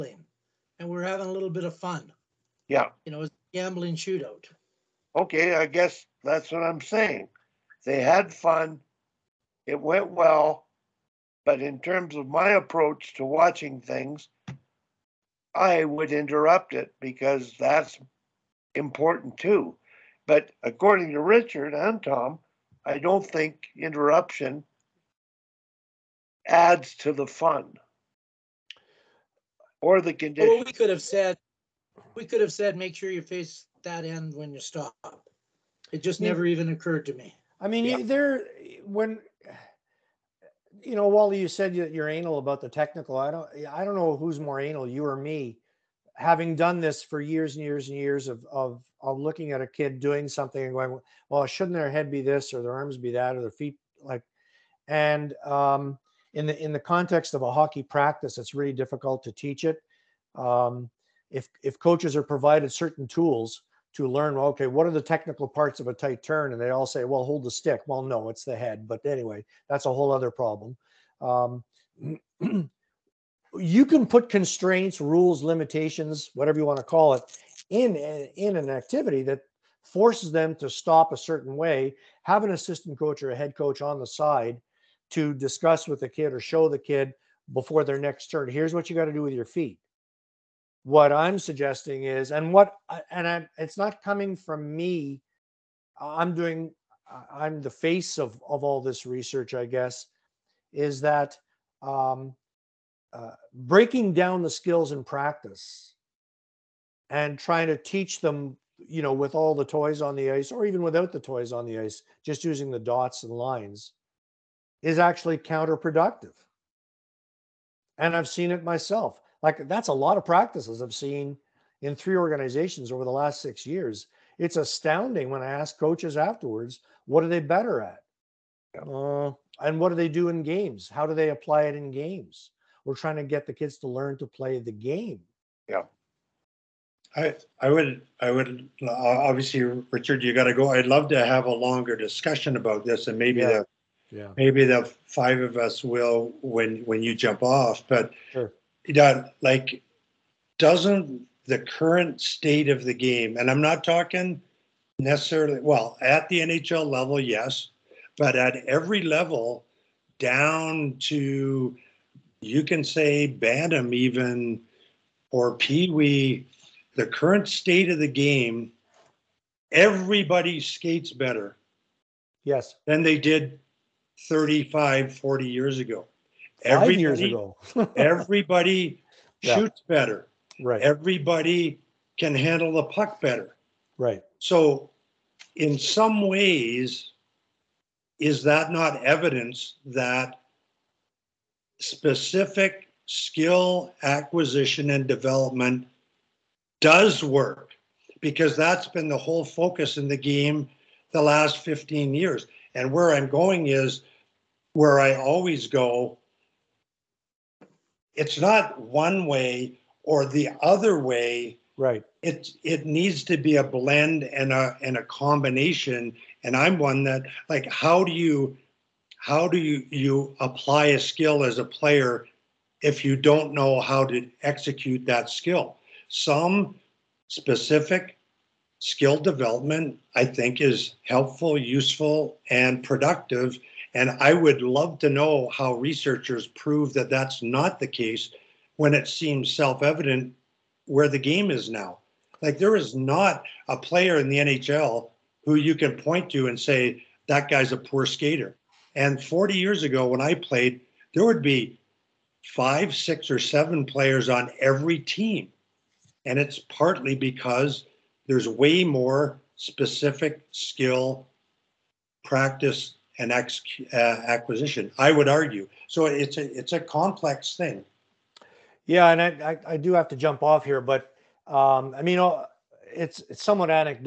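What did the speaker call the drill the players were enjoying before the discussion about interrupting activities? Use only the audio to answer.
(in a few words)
gambling shootout.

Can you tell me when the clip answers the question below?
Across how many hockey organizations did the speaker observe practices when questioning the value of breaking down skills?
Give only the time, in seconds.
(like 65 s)
121 s.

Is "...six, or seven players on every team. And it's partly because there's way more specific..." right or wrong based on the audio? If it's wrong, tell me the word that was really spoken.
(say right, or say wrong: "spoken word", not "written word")
right.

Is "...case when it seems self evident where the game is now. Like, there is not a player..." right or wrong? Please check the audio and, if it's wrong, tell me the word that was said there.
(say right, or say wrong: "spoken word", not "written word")
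right.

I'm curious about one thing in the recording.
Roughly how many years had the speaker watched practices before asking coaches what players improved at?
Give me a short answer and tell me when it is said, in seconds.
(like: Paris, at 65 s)
6, at 123 s.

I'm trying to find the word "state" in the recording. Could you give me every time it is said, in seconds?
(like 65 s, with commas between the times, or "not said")
152 s, 167 s.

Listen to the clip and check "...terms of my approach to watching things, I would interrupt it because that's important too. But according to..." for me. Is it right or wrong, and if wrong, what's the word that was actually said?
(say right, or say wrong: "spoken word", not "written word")
right.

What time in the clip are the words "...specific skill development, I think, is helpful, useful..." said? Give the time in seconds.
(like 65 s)
227 s.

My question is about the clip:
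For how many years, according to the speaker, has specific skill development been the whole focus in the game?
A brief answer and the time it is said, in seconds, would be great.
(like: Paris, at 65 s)
15, at 201 s.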